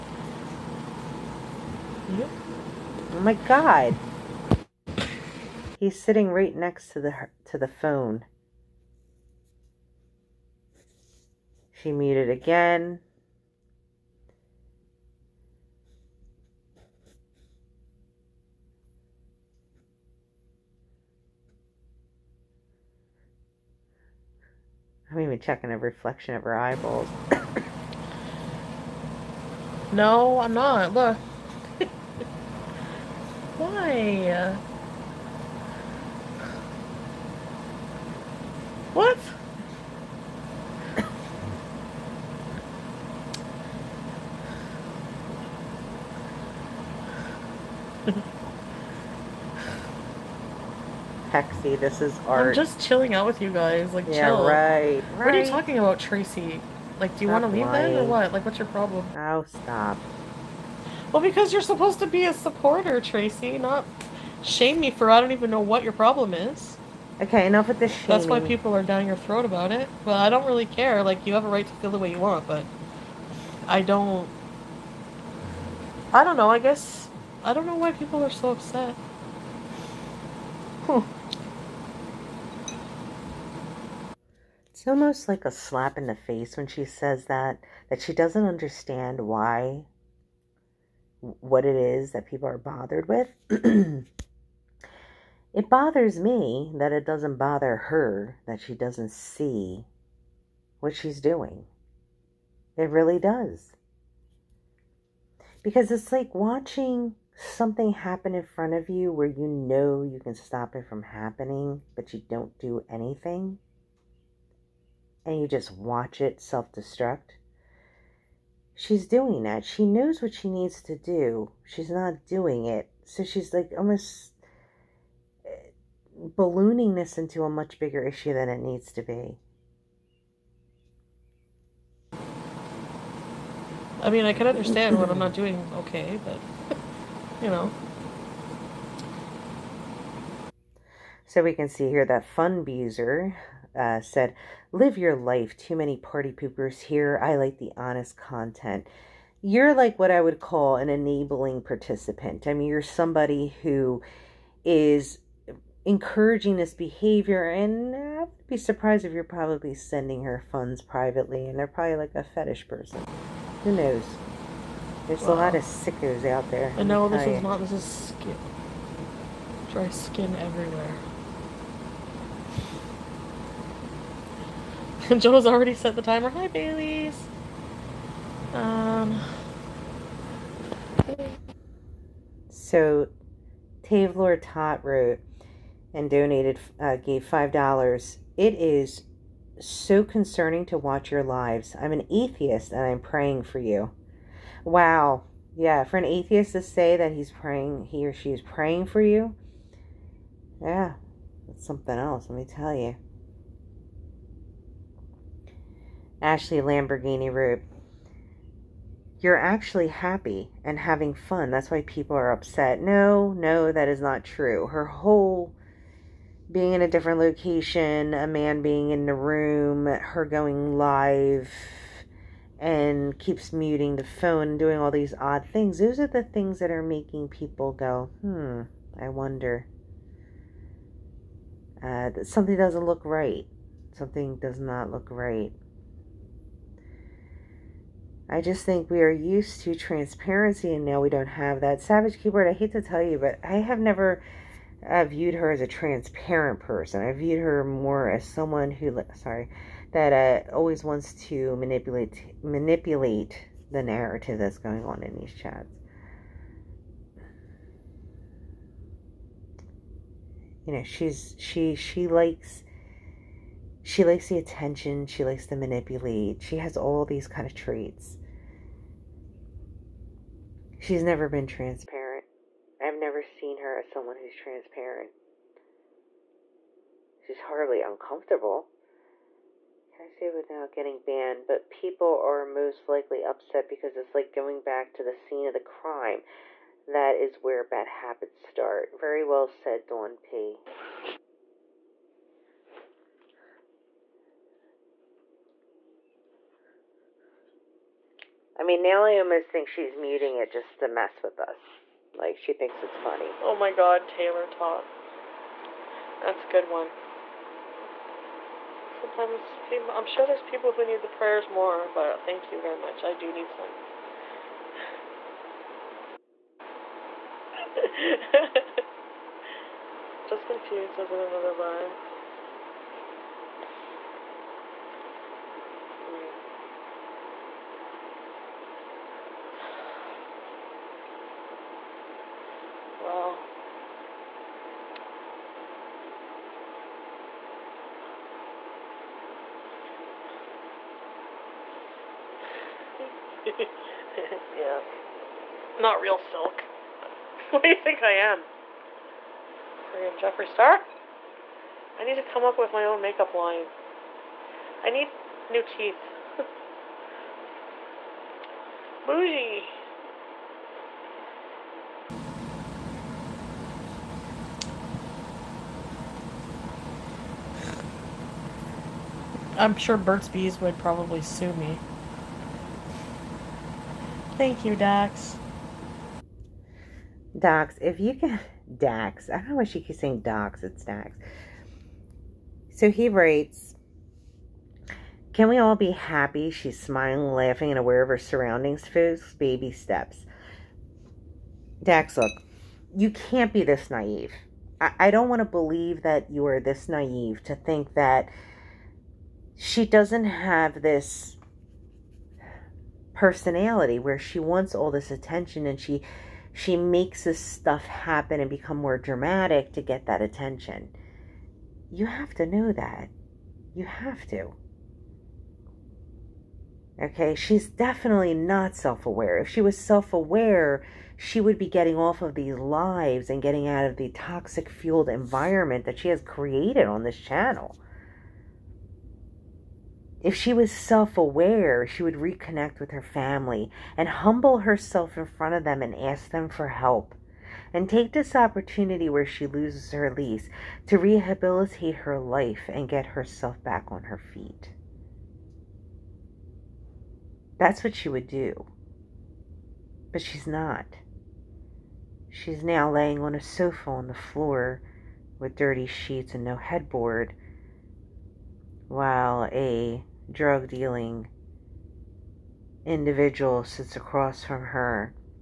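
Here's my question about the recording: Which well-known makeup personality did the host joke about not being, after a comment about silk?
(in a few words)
Jeffree Star.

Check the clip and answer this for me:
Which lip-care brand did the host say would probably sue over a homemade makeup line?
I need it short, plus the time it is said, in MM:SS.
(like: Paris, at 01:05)
Burt's Bees, at 06:09.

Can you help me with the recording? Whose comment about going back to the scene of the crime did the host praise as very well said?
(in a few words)
Dawn P.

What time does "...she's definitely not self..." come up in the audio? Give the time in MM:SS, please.
06:57.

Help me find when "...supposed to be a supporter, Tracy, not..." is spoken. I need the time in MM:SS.
01:01.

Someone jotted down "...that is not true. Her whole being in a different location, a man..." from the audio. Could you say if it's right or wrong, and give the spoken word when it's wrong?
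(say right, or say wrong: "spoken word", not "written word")
right.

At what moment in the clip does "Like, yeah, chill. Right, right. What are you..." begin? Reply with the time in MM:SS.
00:53.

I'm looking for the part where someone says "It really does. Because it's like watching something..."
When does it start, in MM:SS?
01:42.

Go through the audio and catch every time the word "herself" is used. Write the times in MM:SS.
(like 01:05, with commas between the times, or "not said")
07:14, 07:23.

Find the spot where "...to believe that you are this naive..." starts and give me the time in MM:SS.
06:35.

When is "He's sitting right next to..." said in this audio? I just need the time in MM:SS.
00:05.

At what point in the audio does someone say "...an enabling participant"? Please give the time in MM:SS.
02:30.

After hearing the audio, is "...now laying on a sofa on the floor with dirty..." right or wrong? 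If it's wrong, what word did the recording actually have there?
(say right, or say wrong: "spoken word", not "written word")
right.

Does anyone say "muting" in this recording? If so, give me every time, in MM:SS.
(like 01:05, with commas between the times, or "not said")
03:43, 04:59.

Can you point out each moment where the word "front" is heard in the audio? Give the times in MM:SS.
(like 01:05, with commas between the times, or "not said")
01:48, 07:15.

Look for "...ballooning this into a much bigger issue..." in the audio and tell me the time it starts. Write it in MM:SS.
02:06.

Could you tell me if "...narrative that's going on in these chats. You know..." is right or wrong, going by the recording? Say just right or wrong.
right.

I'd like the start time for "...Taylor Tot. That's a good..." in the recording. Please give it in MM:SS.
05:04.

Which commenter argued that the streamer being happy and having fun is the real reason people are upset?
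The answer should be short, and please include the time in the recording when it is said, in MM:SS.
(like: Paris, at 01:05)
Ashley Lamborghini Root, at 03:26.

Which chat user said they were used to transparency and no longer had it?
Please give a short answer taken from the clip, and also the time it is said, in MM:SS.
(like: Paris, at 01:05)
Savage Keyboard, at 04:01.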